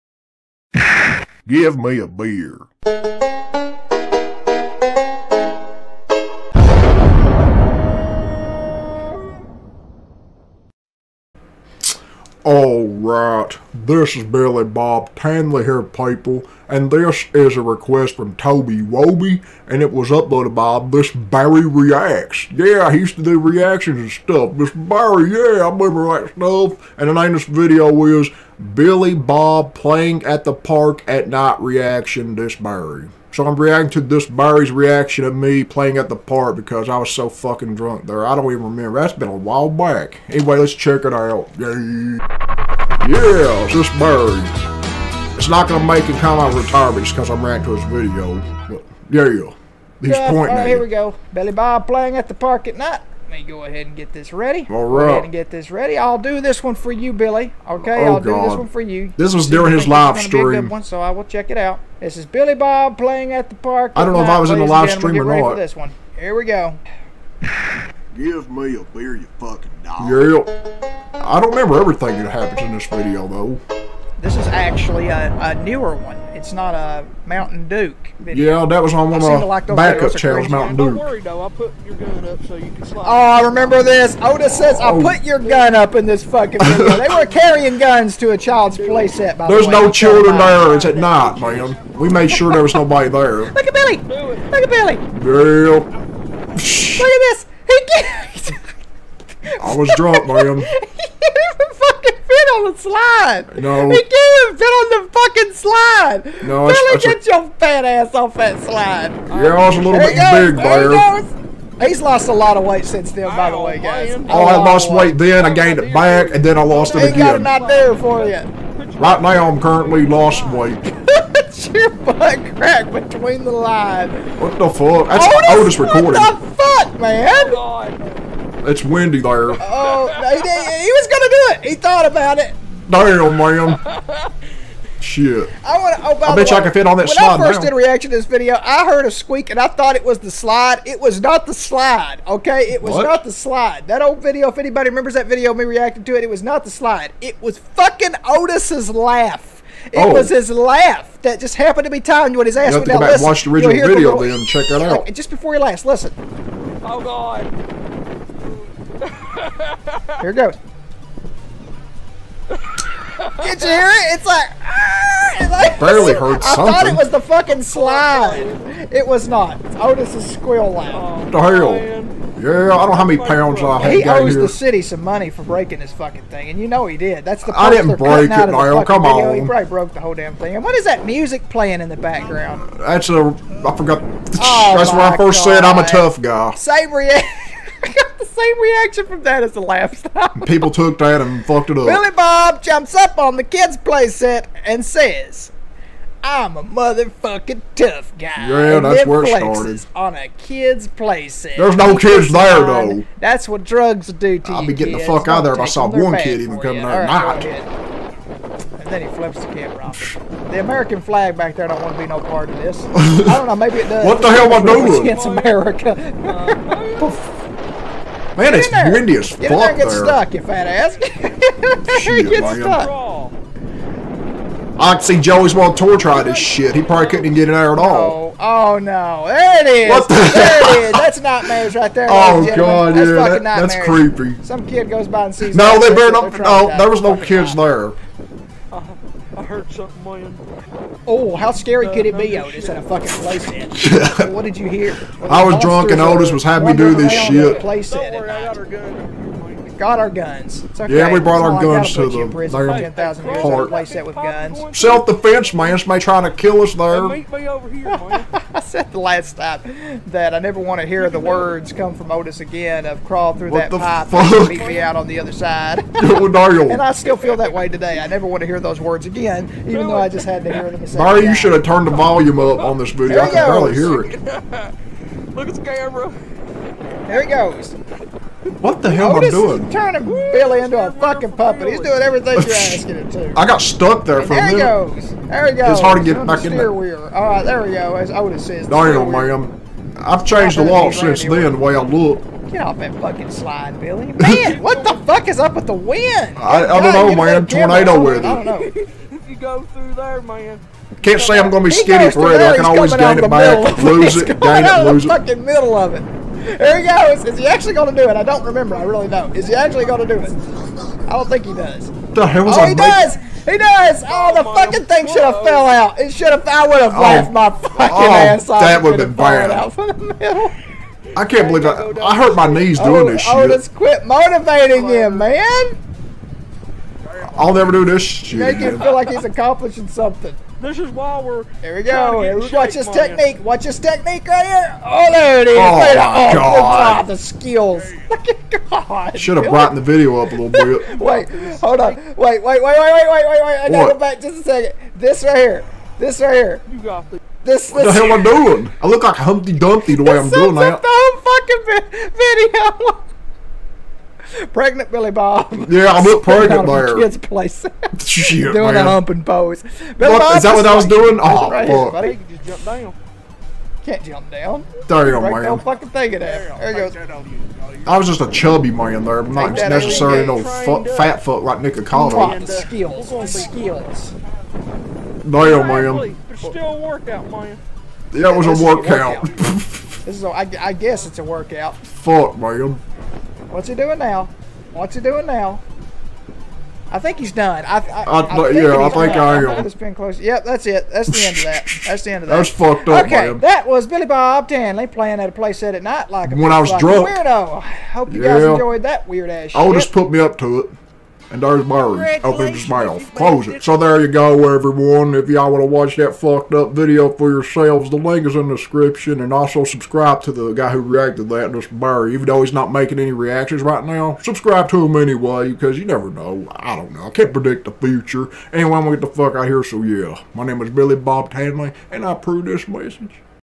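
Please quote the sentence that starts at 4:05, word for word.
Well, I was drunk and Otis was having me do this shit.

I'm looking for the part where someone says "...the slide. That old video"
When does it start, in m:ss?
2:23.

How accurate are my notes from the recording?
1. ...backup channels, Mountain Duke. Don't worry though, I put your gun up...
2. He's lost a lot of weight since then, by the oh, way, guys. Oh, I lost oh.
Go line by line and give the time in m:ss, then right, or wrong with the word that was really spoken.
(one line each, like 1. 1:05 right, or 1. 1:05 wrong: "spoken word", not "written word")
1. 1:19 right
2. 1:51 right.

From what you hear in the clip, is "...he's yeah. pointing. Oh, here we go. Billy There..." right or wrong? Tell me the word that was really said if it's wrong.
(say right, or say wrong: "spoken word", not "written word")
wrong: "Bob", not "There".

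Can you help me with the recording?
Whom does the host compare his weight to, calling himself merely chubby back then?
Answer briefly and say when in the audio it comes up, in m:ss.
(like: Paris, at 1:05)
Nicocado, at 6:11.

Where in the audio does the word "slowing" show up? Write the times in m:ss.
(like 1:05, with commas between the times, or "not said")
not said.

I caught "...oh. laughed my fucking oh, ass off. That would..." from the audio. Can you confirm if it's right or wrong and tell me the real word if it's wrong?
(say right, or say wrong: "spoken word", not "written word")
right.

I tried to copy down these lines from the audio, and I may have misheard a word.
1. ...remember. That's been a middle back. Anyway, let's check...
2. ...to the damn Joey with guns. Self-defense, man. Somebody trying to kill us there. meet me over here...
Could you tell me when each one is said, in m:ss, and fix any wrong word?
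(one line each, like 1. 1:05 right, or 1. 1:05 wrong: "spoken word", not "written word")
1. 0:38 wrong: "while", not "middle"
2. 4:11 wrong: "Place", not "Joey".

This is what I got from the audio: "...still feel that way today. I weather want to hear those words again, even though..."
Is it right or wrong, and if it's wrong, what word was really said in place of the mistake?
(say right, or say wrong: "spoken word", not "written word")
wrong: "never", not "weather".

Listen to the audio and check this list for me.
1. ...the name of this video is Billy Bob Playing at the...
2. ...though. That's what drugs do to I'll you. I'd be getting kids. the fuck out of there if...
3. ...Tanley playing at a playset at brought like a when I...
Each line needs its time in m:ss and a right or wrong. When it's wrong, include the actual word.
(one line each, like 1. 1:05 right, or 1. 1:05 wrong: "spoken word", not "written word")
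1. 0:27 right
2. 3:22 right
3. 6:34 wrong: "night", not "brought".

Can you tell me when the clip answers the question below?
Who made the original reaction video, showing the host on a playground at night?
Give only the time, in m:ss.
0:21.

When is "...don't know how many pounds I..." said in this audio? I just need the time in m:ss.
2:52.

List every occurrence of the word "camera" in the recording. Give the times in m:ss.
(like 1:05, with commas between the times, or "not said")
3:29, 4:35.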